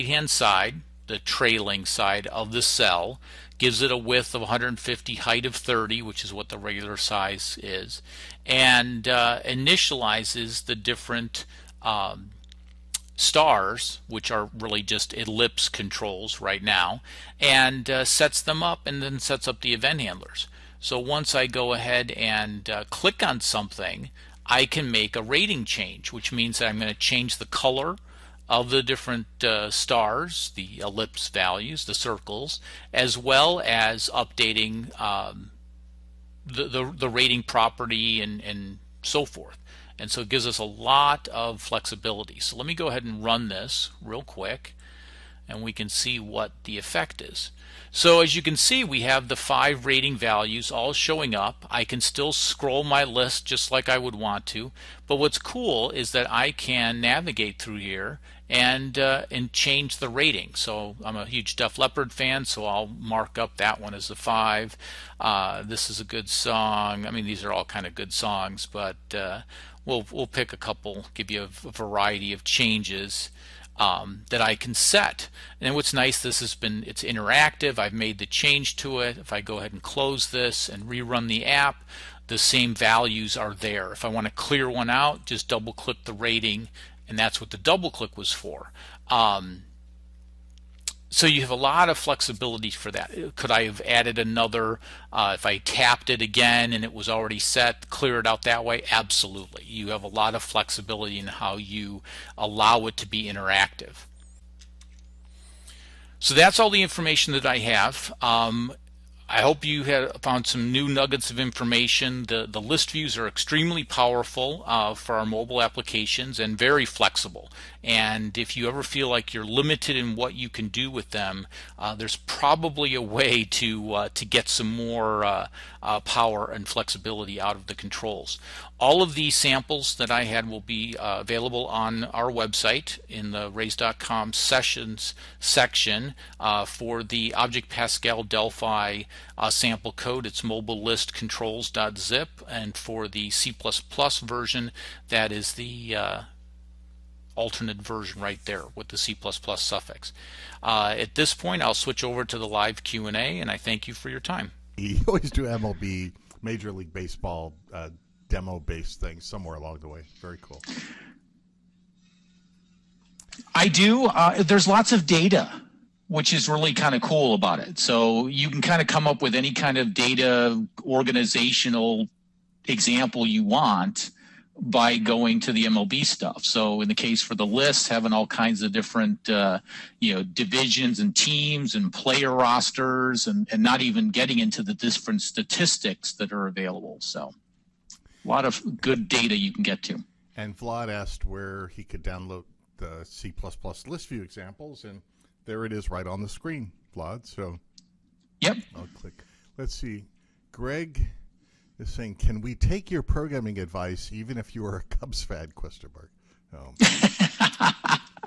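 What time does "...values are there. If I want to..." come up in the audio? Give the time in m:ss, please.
1:22.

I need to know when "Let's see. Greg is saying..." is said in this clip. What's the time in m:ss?
3:19.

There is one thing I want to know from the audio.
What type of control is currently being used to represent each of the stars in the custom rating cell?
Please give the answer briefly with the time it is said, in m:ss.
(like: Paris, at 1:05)
ellipse controls, at 0:15.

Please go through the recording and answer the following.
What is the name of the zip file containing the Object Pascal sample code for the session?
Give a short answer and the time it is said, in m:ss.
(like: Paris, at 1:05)
mobile list controls.zip, at 2:20.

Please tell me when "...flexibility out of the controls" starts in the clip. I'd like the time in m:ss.
2:06.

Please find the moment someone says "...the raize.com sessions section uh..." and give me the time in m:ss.
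2:13.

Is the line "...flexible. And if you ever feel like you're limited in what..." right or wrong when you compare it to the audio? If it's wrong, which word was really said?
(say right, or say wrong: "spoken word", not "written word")
right.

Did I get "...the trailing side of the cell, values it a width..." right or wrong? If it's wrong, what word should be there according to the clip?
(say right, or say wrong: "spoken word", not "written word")
wrong: "gives", not "values".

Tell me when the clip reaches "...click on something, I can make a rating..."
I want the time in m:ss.
0:22.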